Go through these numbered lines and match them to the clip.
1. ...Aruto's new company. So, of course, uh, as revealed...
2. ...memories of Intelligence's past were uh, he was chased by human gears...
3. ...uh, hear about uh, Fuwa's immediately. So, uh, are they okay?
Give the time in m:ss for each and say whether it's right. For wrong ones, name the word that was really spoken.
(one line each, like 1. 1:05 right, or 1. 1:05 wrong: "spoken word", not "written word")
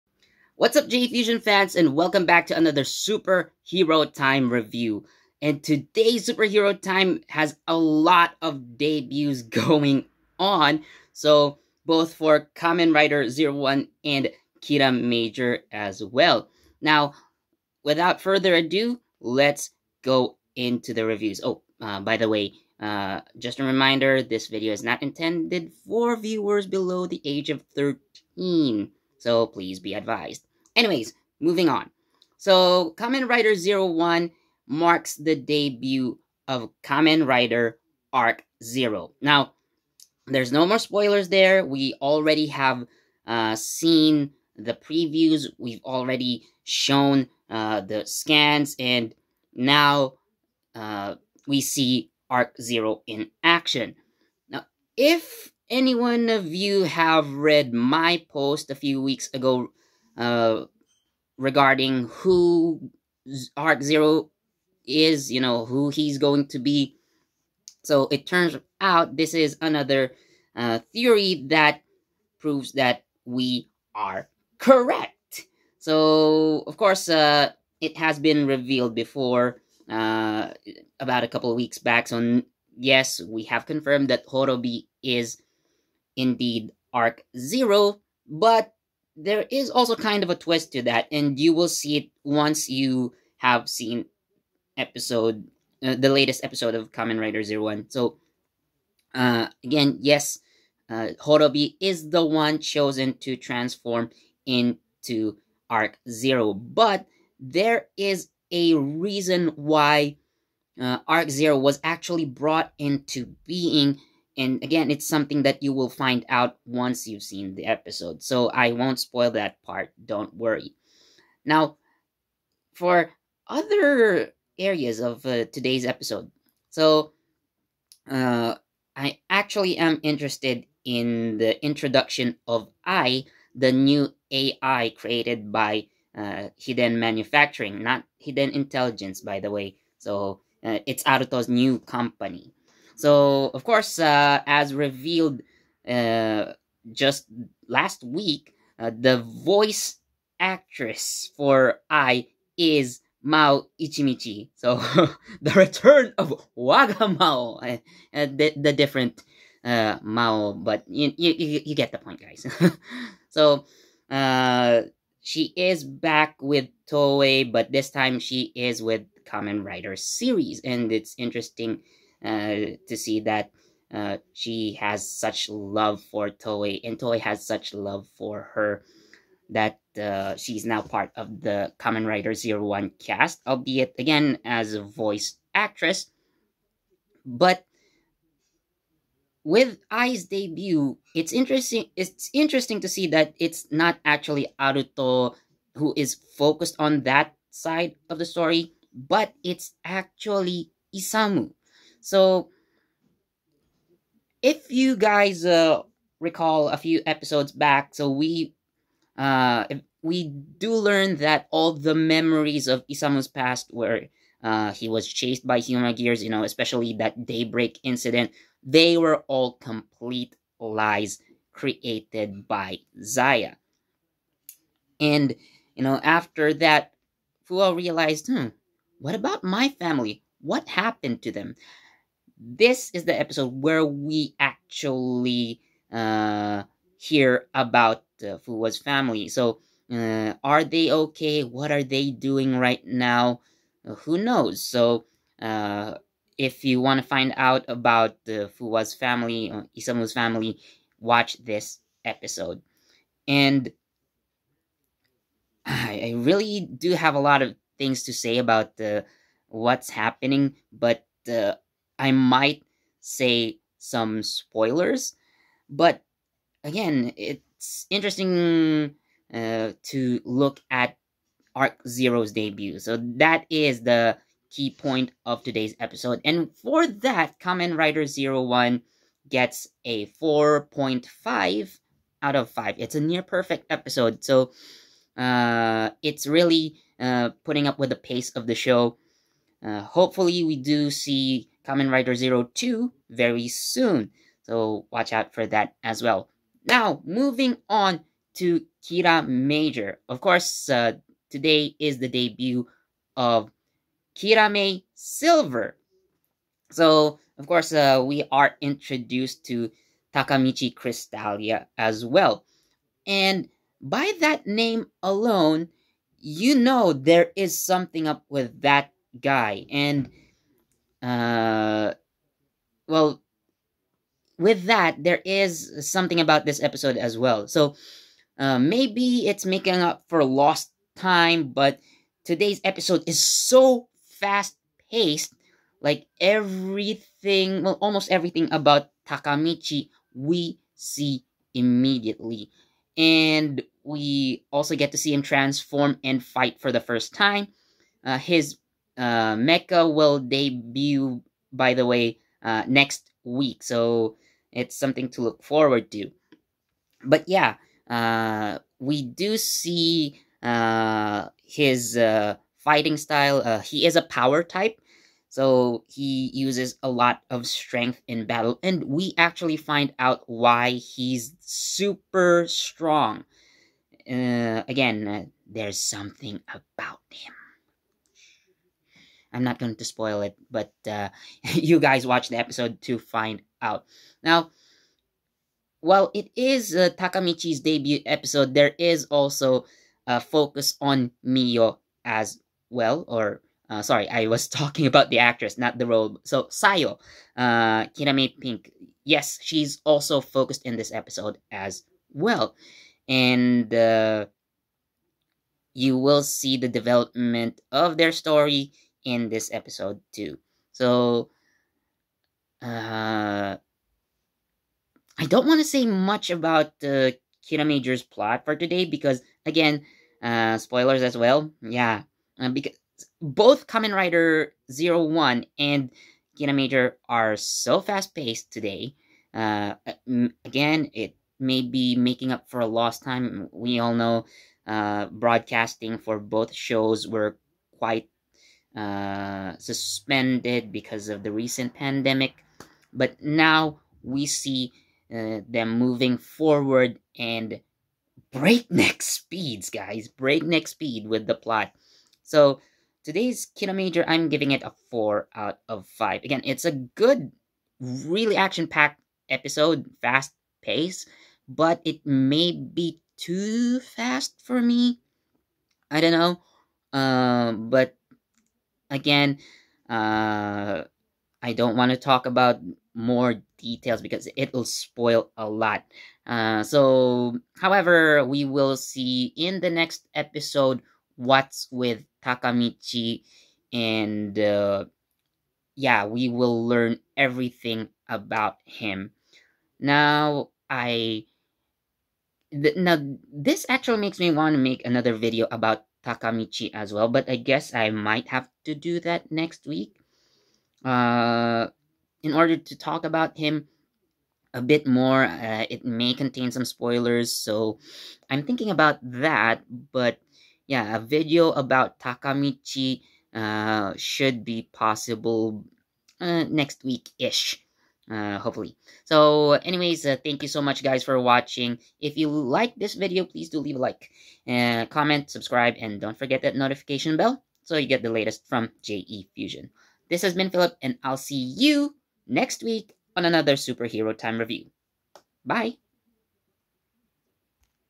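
1. 2:21 right
2. 3:31 wrong: "Isamu", not "Intelligence"
3. 3:55 wrong: "family", not "immediately".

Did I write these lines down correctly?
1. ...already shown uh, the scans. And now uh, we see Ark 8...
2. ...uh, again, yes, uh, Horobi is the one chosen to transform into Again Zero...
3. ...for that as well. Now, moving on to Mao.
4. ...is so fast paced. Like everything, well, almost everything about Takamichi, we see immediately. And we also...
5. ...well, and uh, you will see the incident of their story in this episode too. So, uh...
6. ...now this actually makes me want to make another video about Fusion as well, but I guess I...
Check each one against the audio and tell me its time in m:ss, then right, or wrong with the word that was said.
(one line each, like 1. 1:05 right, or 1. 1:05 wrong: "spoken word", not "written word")
1. 0:45 wrong: "0", not "8"
2. 1:39 wrong: "Ark", not "Again"
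3. 4:55 wrong: "Kiramager", not "Mao"
4. 5:33 right
5. 6:42 wrong: "development", not "incident"
6. 8:12 wrong: "Takamichi", not "Fusion".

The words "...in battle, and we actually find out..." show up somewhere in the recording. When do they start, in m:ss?
6:08.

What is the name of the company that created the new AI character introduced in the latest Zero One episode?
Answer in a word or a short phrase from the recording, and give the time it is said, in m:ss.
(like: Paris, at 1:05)
Hiden Manufacturing, at 2:16.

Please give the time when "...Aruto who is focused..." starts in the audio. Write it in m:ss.
3:14.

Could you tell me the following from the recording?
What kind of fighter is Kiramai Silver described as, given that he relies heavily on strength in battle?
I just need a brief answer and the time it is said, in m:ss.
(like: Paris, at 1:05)
power type, at 6:04.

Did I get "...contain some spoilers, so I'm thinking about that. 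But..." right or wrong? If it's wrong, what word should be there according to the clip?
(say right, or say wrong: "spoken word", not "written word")
right.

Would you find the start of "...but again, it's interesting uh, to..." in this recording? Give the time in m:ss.
4:25.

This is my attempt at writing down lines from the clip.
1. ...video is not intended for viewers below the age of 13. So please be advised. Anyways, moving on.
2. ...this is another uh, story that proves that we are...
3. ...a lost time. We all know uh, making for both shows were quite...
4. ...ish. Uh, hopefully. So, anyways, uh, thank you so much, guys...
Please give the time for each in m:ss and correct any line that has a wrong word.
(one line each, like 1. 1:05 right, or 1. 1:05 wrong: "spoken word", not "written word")
1. 0:24 right
2. 1:09 wrong: "theory", not "story"
3. 7:12 wrong: "broadcasting", not "making"
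4. 8:37 right.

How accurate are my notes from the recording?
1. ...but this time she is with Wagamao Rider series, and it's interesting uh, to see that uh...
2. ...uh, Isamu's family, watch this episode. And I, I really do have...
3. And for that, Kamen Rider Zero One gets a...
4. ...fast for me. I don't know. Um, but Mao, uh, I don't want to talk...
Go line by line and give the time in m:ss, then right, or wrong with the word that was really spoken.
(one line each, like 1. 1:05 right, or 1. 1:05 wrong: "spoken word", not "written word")
1. 2:47 wrong: "Kamen", not "Wagamao"
2. 4:09 right
3. 4:36 right
4. 7:43 wrong: "Again", not "Mao".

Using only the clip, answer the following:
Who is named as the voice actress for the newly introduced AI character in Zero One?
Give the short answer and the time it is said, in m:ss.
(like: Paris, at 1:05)
Mao Ichimichi, at 2:33.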